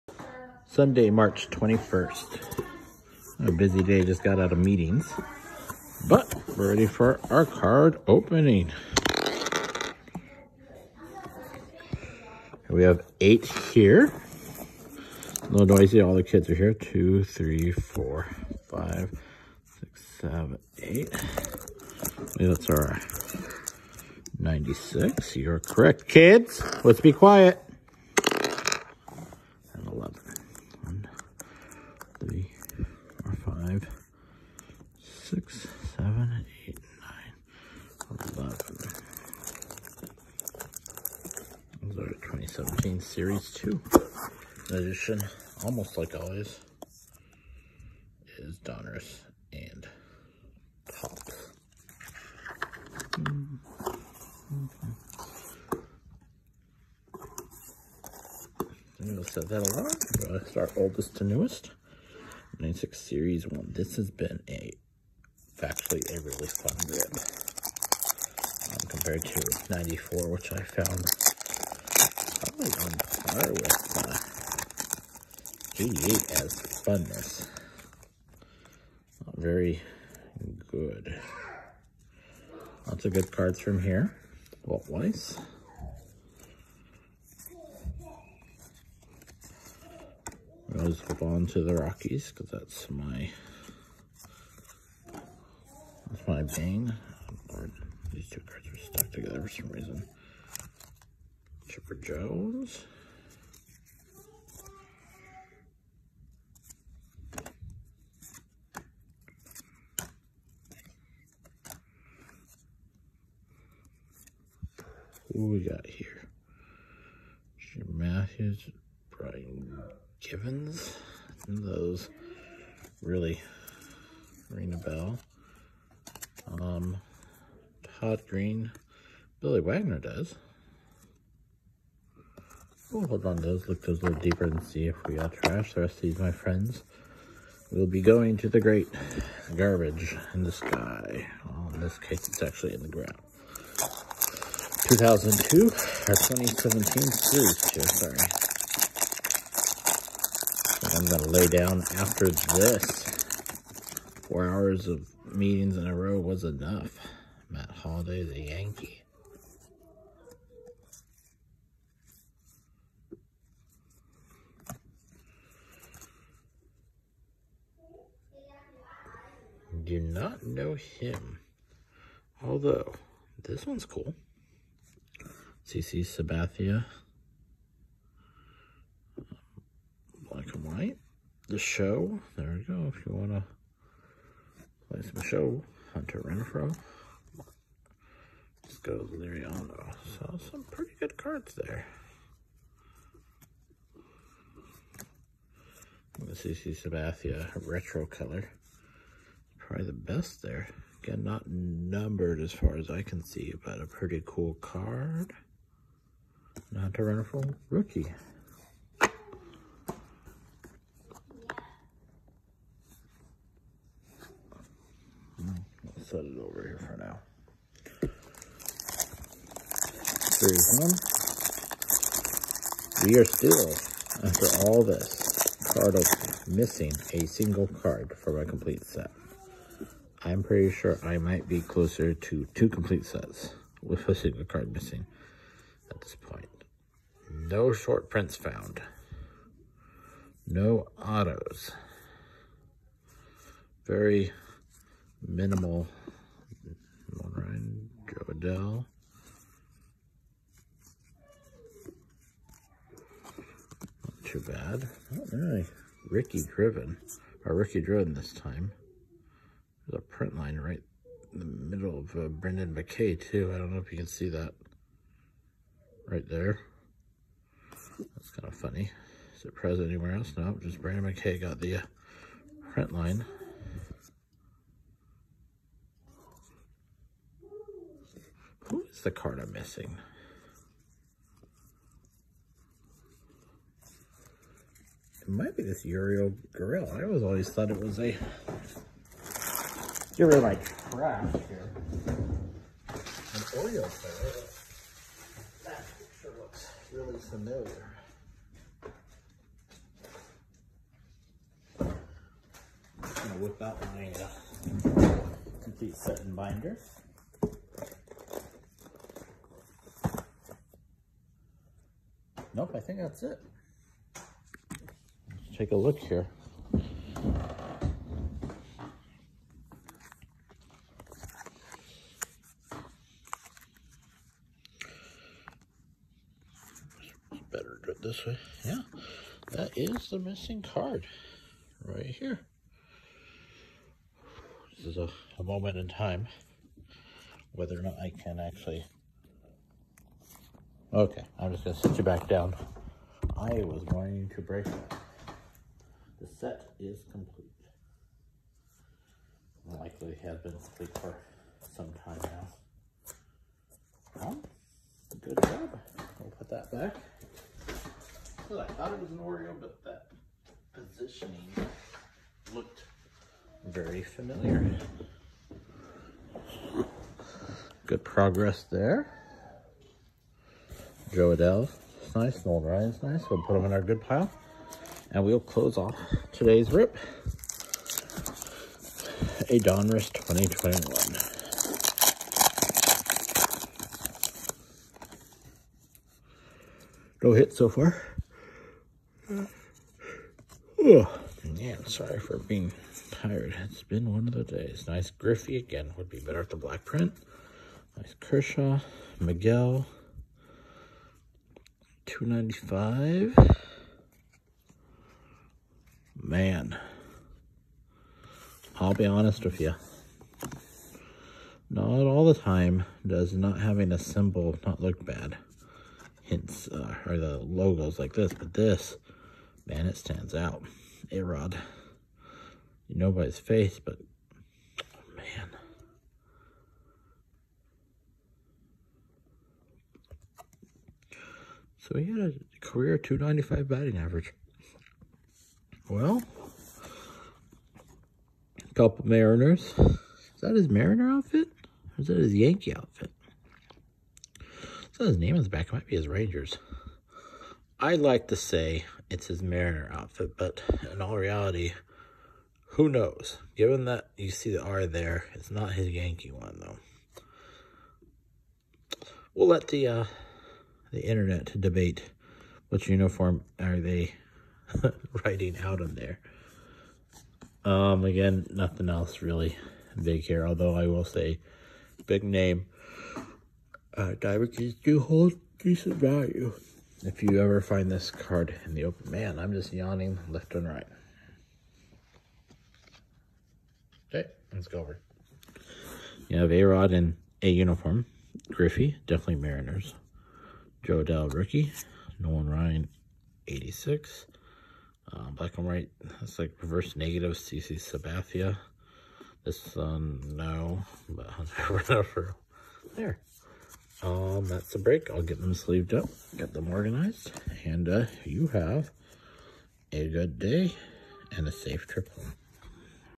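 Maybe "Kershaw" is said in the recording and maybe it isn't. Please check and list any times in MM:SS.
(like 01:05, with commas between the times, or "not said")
06:38.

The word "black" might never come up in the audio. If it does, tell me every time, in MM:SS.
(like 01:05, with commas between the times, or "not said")
03:00, 06:36, 08:15.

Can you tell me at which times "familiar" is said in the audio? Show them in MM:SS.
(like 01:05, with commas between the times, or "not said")
04:57, 06:04.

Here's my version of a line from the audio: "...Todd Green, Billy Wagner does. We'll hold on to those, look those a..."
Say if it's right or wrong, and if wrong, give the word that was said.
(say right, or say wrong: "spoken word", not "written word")
right.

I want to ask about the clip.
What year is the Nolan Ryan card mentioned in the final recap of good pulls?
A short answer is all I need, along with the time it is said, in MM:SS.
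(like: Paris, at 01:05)
1986, at 08:13.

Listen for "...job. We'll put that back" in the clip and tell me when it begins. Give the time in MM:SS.
05:55.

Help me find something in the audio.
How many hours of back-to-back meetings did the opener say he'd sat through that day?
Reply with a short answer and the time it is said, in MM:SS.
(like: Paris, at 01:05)
4, at 02:34.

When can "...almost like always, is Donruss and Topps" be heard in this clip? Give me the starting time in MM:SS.
00:45.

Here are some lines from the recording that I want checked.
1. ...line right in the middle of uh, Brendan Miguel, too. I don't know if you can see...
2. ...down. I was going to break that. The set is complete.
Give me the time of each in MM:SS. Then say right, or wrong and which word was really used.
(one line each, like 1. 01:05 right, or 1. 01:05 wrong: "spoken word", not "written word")
1. 04:20 wrong: "McKay", not "Miguel"
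2. 05:42 right.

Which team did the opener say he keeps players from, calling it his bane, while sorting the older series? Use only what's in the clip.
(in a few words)
Rockies.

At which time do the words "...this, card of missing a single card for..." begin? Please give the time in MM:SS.
03:44.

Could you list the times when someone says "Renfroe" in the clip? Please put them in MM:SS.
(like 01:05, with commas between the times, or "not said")
03:06, 03:27.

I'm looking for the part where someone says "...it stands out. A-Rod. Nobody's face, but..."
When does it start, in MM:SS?
06:59.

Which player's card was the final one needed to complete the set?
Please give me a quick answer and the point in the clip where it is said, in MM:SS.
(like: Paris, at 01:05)
Uriel Grill, at 04:45.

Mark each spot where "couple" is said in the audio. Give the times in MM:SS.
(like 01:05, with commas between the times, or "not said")
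07:18.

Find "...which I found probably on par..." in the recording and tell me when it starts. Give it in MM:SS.
01:10.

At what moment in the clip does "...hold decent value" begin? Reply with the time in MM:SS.
07:55.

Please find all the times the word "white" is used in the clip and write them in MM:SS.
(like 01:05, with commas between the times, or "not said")
03:00, 08:15.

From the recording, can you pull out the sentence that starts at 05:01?
I'm gonna whip out my uh, complete set and binder.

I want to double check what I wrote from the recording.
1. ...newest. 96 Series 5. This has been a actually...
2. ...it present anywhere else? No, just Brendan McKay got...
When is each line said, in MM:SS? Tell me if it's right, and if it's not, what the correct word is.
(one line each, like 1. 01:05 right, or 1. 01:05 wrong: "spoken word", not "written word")
1. 01:01 wrong: "1", not "5"
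2. 04:29 right.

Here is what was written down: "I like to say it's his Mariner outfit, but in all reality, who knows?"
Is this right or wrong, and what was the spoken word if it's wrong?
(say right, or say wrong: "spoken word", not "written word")
right.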